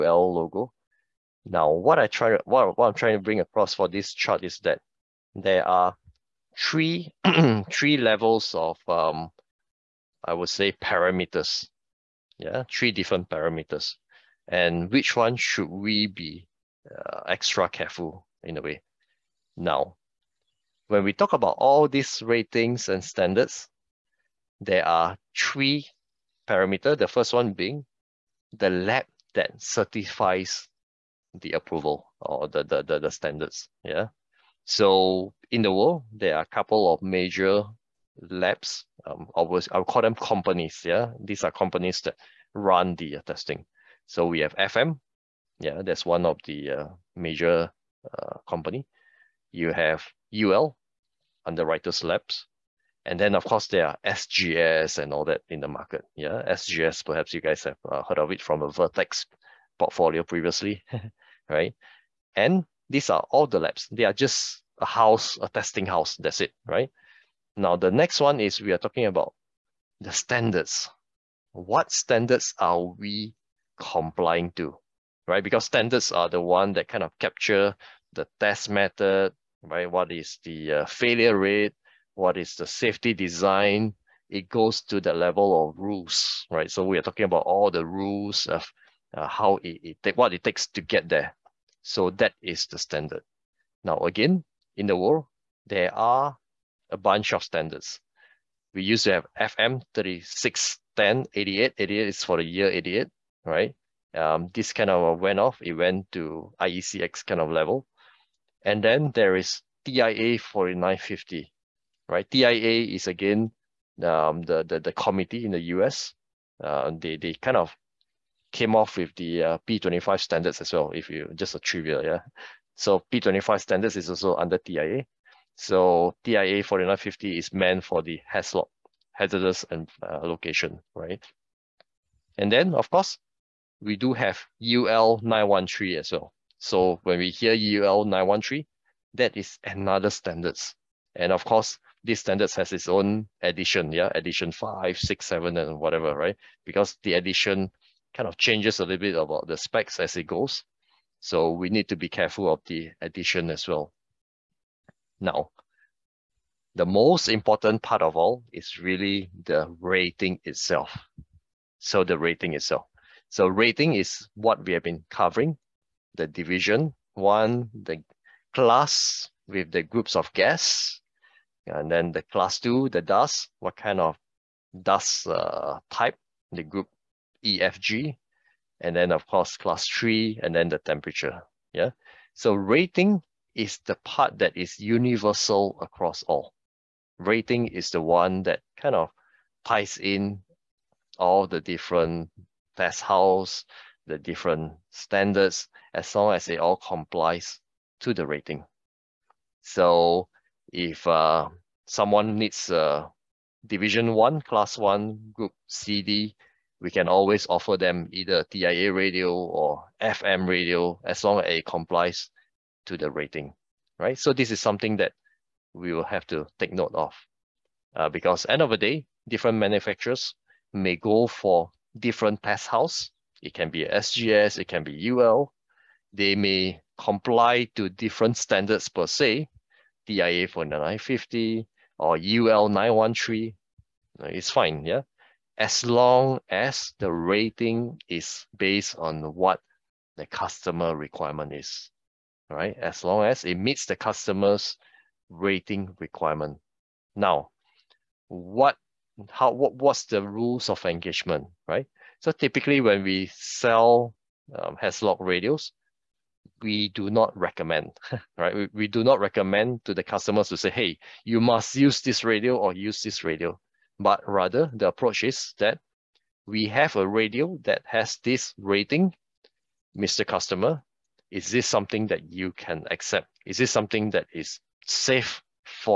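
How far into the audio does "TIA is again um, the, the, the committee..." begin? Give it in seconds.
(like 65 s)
112 s.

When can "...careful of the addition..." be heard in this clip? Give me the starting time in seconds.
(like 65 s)
152 s.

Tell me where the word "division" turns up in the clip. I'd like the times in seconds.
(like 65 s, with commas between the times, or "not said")
166 s, 203 s.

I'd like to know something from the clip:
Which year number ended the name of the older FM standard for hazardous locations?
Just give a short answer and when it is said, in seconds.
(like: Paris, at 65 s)
88, at 101 s.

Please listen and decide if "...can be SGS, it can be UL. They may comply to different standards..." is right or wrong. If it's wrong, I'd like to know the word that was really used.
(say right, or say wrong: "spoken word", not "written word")
right.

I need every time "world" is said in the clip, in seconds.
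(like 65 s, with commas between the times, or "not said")
35 s, 94 s.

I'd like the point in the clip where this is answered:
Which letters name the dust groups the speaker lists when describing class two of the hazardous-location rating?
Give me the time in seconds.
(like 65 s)
176 s.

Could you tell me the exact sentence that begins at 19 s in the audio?
Now, when we talk about all these ratings and standards, there are three parameters.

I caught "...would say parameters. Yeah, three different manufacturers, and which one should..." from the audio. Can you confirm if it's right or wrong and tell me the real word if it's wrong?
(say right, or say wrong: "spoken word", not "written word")
wrong: "parameters", not "manufacturers".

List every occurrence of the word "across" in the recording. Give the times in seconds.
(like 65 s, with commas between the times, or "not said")
3 s, 185 s.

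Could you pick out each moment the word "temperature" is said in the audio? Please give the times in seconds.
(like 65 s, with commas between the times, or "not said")
180 s.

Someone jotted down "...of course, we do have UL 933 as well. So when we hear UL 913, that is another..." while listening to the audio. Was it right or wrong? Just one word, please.
wrong.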